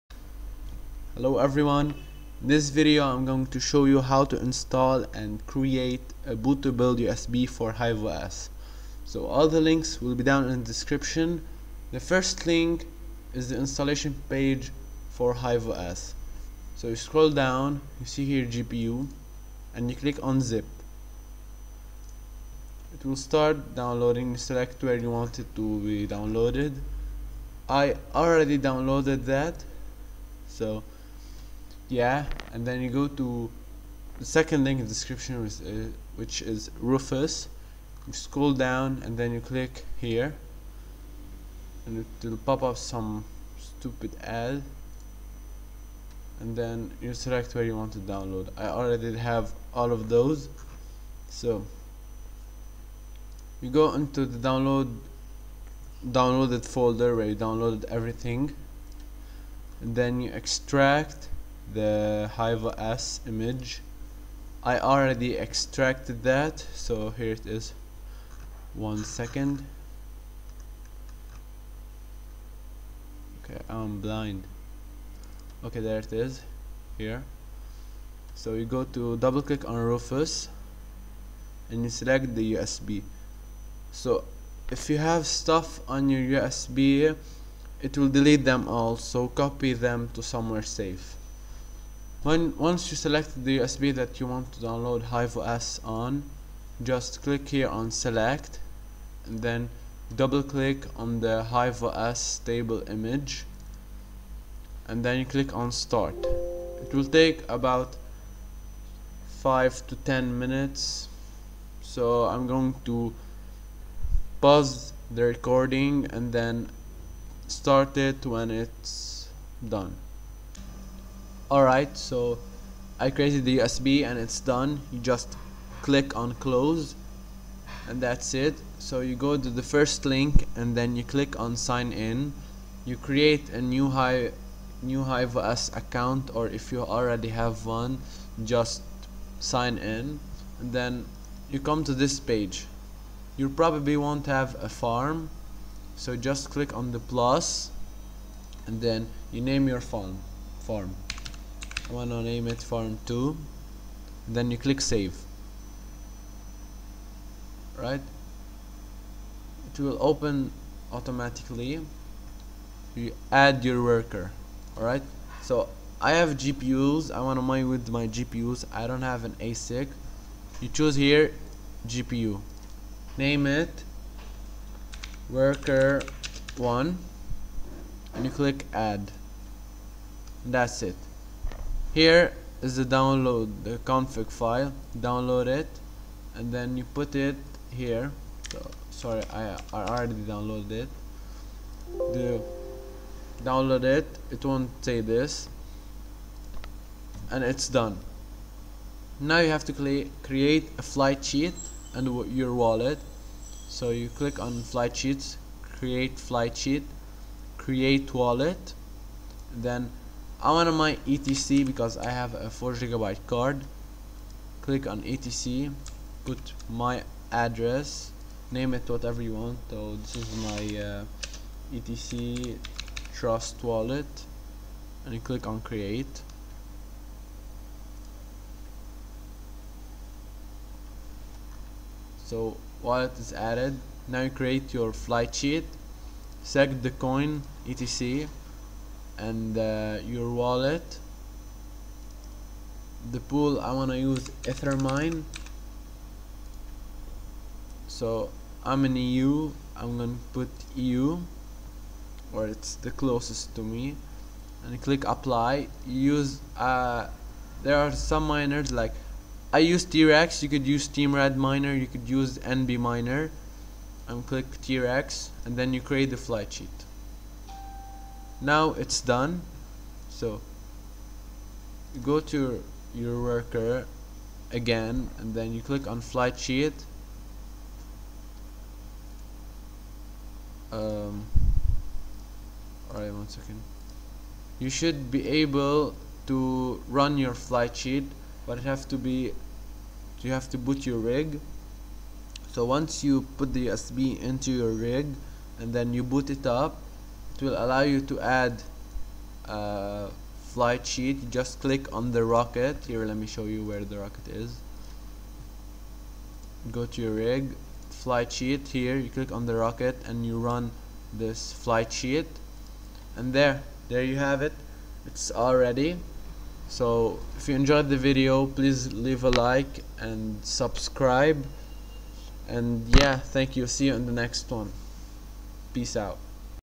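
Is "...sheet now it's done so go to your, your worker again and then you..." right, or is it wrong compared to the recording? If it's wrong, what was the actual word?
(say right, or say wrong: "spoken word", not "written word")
right.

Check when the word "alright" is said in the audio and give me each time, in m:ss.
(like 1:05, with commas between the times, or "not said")
2:01, 2:44, 4:42.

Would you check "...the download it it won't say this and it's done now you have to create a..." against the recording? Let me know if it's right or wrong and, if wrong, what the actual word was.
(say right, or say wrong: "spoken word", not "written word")
right.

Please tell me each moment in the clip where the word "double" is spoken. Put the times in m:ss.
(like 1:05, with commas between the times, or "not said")
1:19, 1:40.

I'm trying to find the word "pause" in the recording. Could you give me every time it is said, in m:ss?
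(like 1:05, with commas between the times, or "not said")
1:54.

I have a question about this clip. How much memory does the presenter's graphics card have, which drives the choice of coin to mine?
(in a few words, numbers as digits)
4 gigabytes.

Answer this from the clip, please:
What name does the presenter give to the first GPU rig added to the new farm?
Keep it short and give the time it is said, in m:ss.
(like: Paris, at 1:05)
worker 1, at 2:55.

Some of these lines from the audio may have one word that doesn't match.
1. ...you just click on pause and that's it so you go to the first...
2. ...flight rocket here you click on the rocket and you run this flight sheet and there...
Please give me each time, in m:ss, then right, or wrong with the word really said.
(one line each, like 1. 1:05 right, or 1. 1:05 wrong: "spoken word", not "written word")
1. 2:04 wrong: "close", not "pause"
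2. 5:07 wrong: "sheet", not "rocket".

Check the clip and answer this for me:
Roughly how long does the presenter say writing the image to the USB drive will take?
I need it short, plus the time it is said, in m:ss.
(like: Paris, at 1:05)
5 to 10 minutes, at 1:49.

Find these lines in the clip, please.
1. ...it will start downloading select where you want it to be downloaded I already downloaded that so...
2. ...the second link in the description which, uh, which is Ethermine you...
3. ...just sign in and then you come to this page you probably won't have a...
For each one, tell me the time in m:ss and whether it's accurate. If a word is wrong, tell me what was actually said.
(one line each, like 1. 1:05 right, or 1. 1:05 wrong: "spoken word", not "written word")
1. 0:22 right
2. 0:34 wrong: "Rufus", not "Ethermine"
3. 2:18 right.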